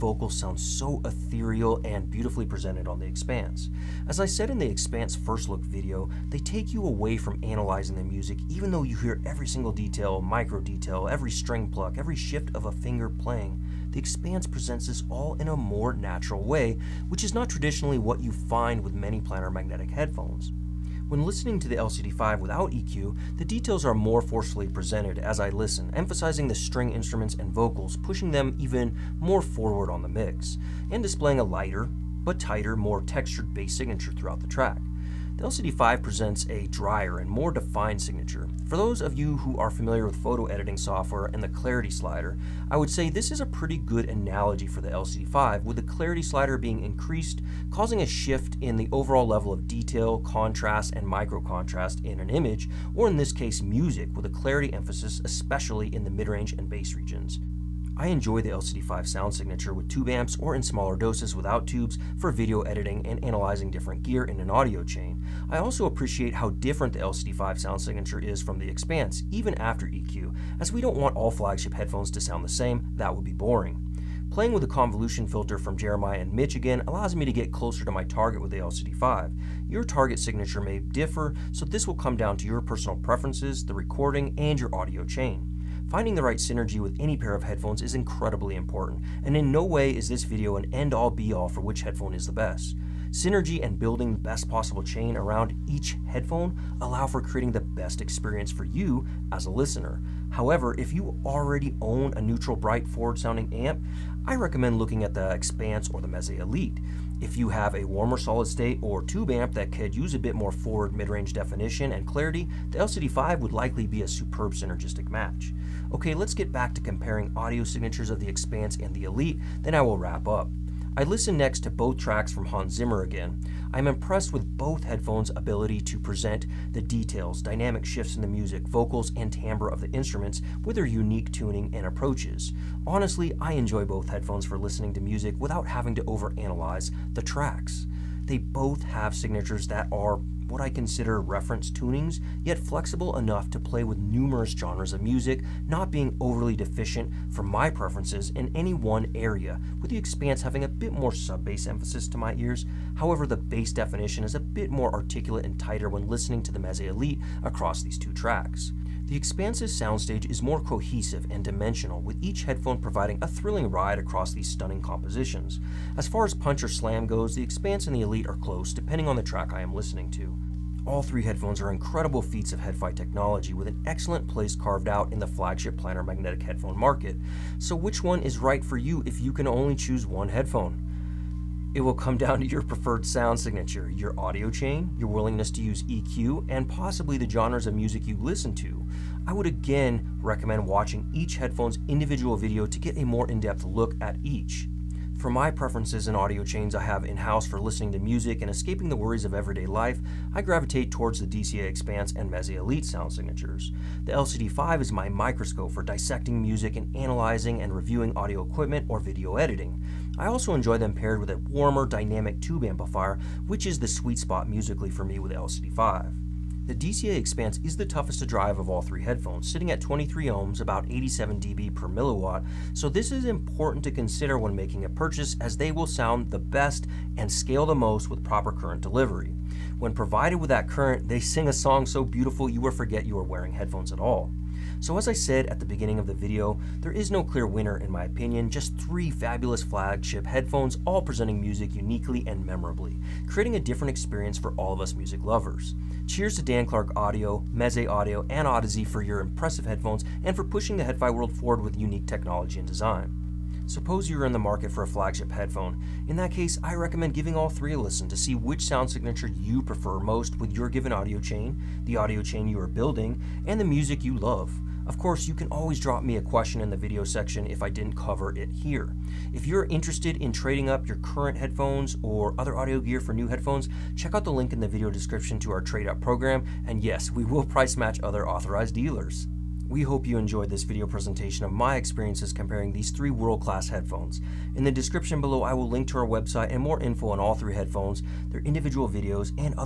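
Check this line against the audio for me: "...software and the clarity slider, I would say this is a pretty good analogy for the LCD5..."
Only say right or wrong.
right.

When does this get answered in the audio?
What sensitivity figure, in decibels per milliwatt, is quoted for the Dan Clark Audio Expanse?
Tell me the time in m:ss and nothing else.
3:40.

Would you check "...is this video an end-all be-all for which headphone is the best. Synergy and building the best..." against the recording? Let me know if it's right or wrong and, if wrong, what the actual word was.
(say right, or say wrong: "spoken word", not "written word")
right.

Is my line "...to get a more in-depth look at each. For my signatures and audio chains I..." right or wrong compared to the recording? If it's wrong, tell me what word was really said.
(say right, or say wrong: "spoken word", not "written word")
wrong: "preferences", not "signatures".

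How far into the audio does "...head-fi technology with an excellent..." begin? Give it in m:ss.
2:52.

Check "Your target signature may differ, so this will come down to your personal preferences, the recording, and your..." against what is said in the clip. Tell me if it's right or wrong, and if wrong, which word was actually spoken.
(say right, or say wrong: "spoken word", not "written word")
right.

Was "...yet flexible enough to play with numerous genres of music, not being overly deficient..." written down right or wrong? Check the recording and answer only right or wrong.
right.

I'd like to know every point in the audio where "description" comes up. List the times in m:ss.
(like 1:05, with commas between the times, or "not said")
4:34, 4:44.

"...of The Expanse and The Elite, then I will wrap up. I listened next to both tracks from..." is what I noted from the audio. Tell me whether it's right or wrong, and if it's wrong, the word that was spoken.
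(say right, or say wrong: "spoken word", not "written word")
right.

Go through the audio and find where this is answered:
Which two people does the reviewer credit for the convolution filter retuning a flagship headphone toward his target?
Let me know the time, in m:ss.
1:15.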